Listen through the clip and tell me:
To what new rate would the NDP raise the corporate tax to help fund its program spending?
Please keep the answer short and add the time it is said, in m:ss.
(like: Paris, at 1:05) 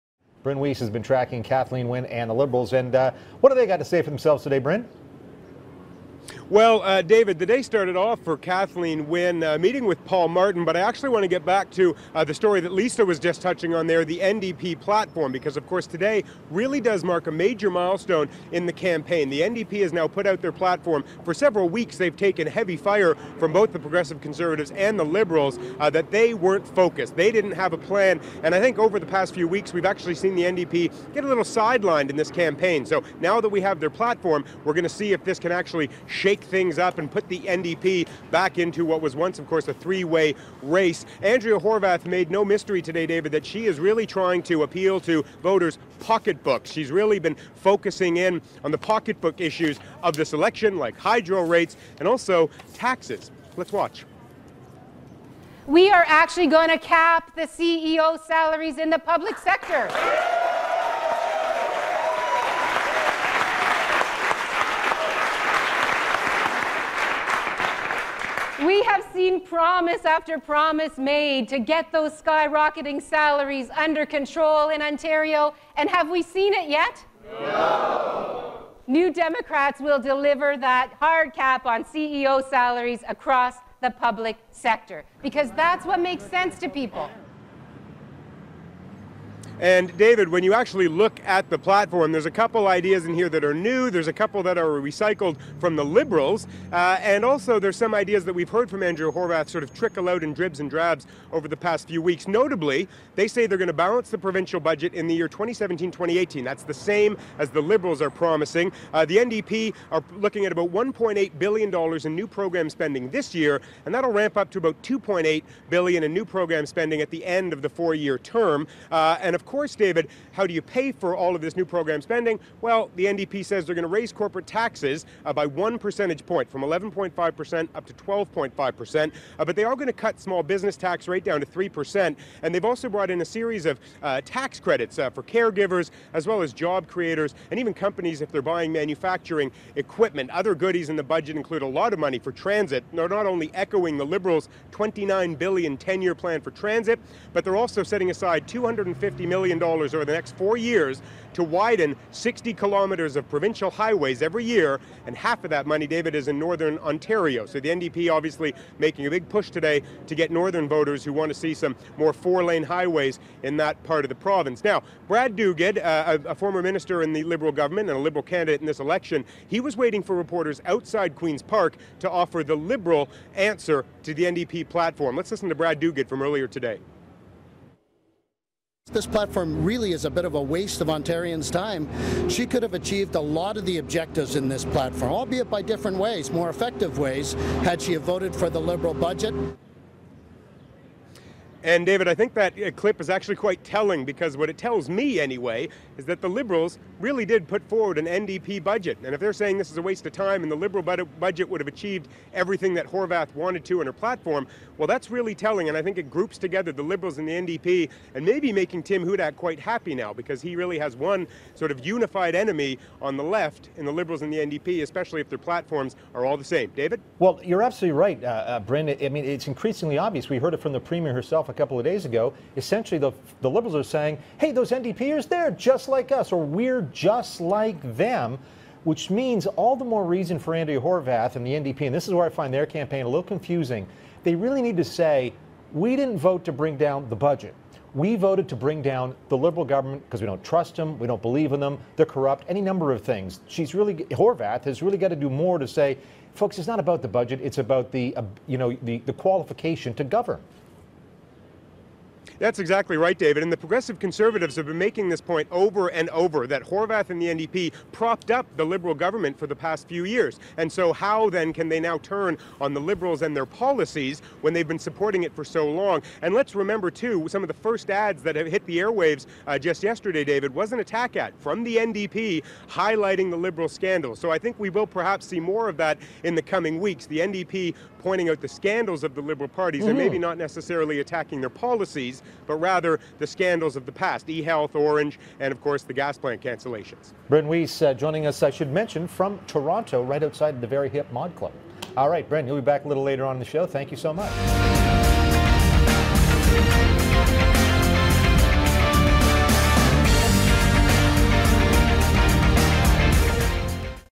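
12.5%, at 2:07.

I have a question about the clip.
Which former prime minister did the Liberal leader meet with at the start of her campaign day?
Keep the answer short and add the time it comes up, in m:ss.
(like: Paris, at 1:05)
Paul Martin, at 0:10.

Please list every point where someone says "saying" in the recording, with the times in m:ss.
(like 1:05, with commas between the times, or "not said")
3:19, 3:43.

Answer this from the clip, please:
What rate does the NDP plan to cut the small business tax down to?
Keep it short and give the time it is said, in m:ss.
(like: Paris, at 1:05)
3%, at 2:11.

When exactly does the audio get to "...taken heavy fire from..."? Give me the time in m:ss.
0:22.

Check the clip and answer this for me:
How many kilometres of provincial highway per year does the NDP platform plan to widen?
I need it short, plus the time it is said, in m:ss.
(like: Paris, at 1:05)
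60, at 2:32.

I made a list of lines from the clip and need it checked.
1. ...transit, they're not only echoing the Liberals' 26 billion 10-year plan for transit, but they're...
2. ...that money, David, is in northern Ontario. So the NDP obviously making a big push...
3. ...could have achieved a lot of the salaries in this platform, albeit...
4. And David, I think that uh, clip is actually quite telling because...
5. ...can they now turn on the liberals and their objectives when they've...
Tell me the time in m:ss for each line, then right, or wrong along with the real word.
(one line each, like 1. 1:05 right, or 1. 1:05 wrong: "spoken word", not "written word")
1. 2:22 wrong: "29", not "26"
2. 2:35 right
3. 3:02 wrong: "objectives", not "salaries"
4. 3:11 right
5. 4:21 wrong: "policies", not "objectives".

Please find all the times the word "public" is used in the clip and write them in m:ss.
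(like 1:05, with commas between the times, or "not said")
0:58, 1:23.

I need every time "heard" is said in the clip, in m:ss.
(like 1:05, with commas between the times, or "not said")
1:38, 3:40.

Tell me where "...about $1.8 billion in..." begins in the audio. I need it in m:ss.
1:50.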